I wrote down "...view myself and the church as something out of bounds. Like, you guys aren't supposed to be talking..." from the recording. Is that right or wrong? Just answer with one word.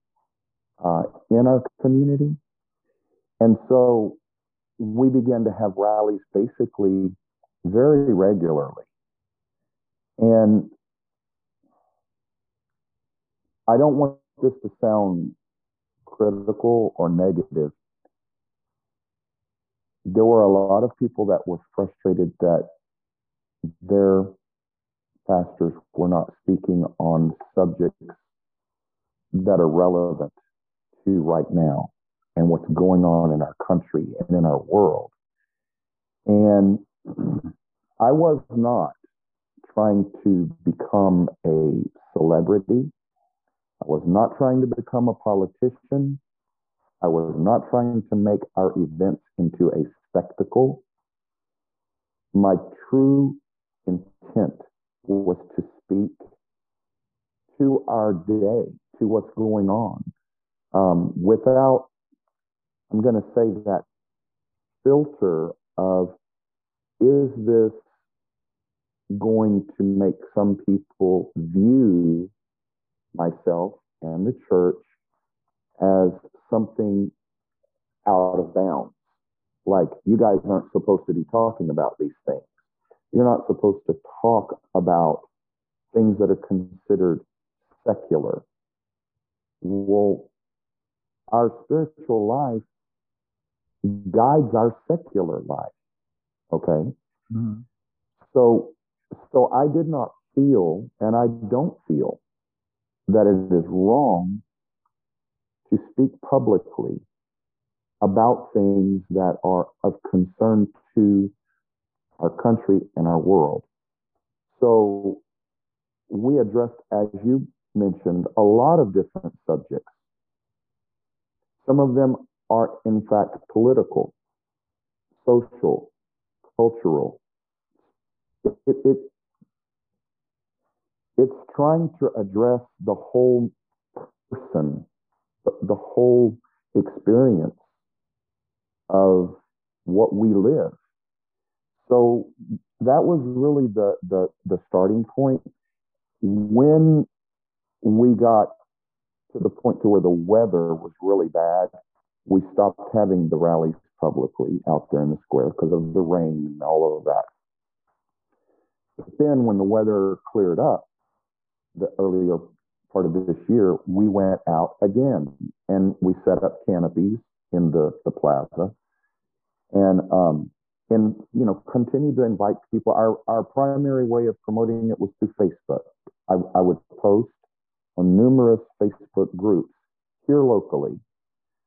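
right.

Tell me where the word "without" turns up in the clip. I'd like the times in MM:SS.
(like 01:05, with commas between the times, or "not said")
01:01.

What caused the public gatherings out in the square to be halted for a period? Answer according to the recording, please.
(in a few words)
The rain.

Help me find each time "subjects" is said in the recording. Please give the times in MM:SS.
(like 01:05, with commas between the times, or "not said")
00:27, 01:59.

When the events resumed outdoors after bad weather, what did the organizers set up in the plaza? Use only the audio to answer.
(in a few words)
Canopies.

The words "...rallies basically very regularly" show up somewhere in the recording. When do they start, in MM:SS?
00:05.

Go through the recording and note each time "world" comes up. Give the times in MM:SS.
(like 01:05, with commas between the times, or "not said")
00:34, 01:53.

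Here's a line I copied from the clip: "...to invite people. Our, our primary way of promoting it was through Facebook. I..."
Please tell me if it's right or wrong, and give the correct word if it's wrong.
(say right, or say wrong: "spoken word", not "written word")
right.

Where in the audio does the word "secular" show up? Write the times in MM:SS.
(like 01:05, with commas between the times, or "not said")
01:27, 01:34.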